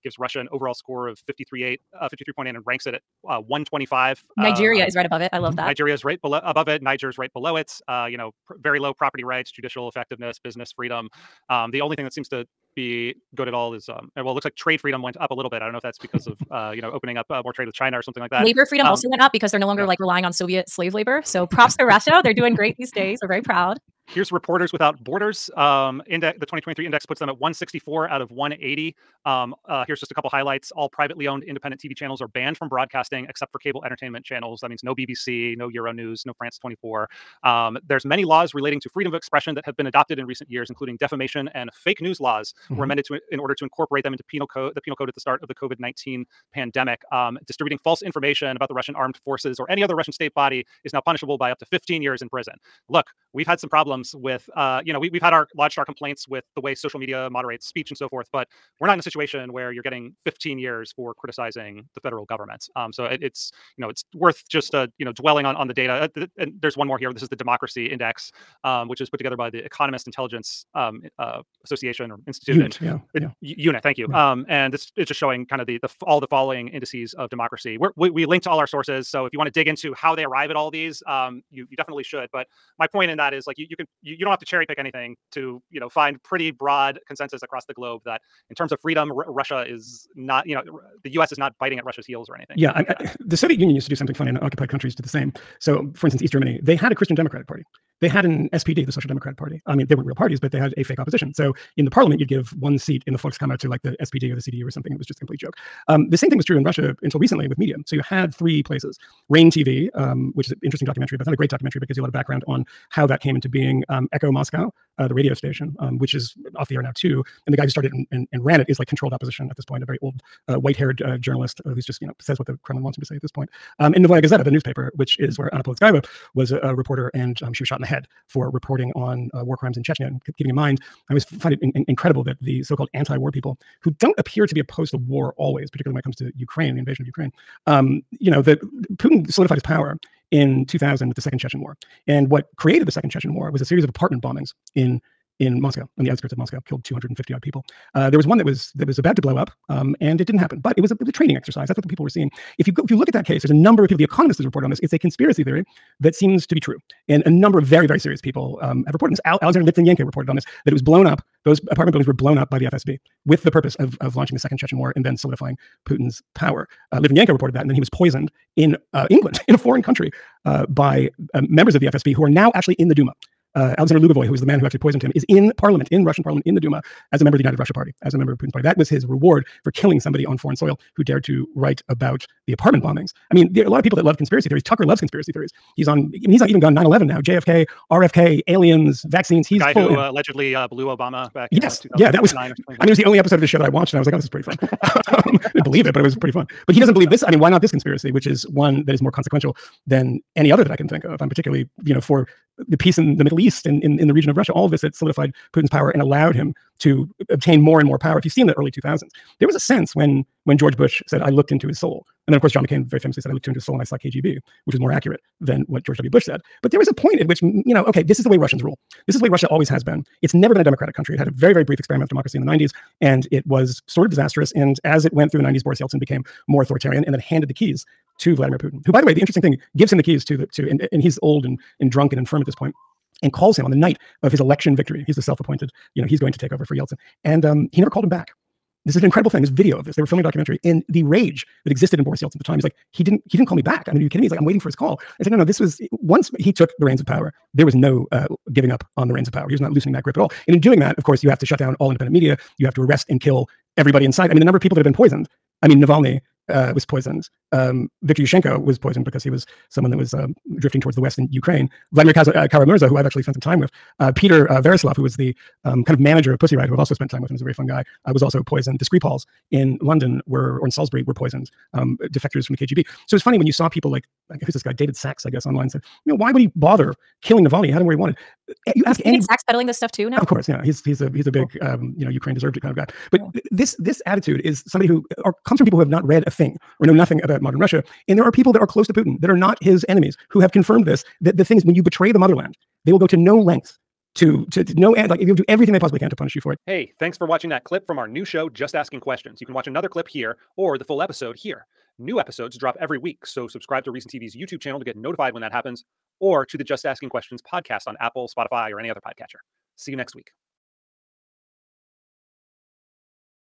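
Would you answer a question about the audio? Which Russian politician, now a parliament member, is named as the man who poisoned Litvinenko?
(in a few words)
Alexander Lugovoy.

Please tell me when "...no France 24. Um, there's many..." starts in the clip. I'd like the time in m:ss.
0:36.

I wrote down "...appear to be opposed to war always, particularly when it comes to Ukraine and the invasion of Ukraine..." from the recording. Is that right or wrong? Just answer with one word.
right.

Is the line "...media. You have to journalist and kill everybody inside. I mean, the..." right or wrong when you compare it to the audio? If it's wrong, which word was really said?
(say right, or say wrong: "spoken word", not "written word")
wrong: "arrest", not "journalist".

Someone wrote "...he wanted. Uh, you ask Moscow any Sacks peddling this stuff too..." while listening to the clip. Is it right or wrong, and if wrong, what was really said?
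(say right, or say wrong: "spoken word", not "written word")
wrong: "David", not "Moscow".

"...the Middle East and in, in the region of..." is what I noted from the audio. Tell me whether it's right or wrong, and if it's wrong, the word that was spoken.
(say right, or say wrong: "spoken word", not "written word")
right.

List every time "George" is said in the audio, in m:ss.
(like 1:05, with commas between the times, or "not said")
3:30, 3:35.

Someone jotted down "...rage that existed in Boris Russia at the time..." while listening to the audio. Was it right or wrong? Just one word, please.
wrong.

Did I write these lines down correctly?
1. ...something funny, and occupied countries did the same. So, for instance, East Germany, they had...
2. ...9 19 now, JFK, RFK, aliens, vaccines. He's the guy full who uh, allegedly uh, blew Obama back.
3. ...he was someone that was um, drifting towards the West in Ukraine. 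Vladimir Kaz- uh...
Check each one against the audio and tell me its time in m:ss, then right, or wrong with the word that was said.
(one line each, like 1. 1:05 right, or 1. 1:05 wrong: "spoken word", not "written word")
1. 1:33 right
2. 3:06 wrong: "11", not "19"
3. 4:19 right.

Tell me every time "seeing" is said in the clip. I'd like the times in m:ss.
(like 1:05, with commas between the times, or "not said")
2:32.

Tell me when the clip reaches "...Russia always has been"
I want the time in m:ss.
3:39.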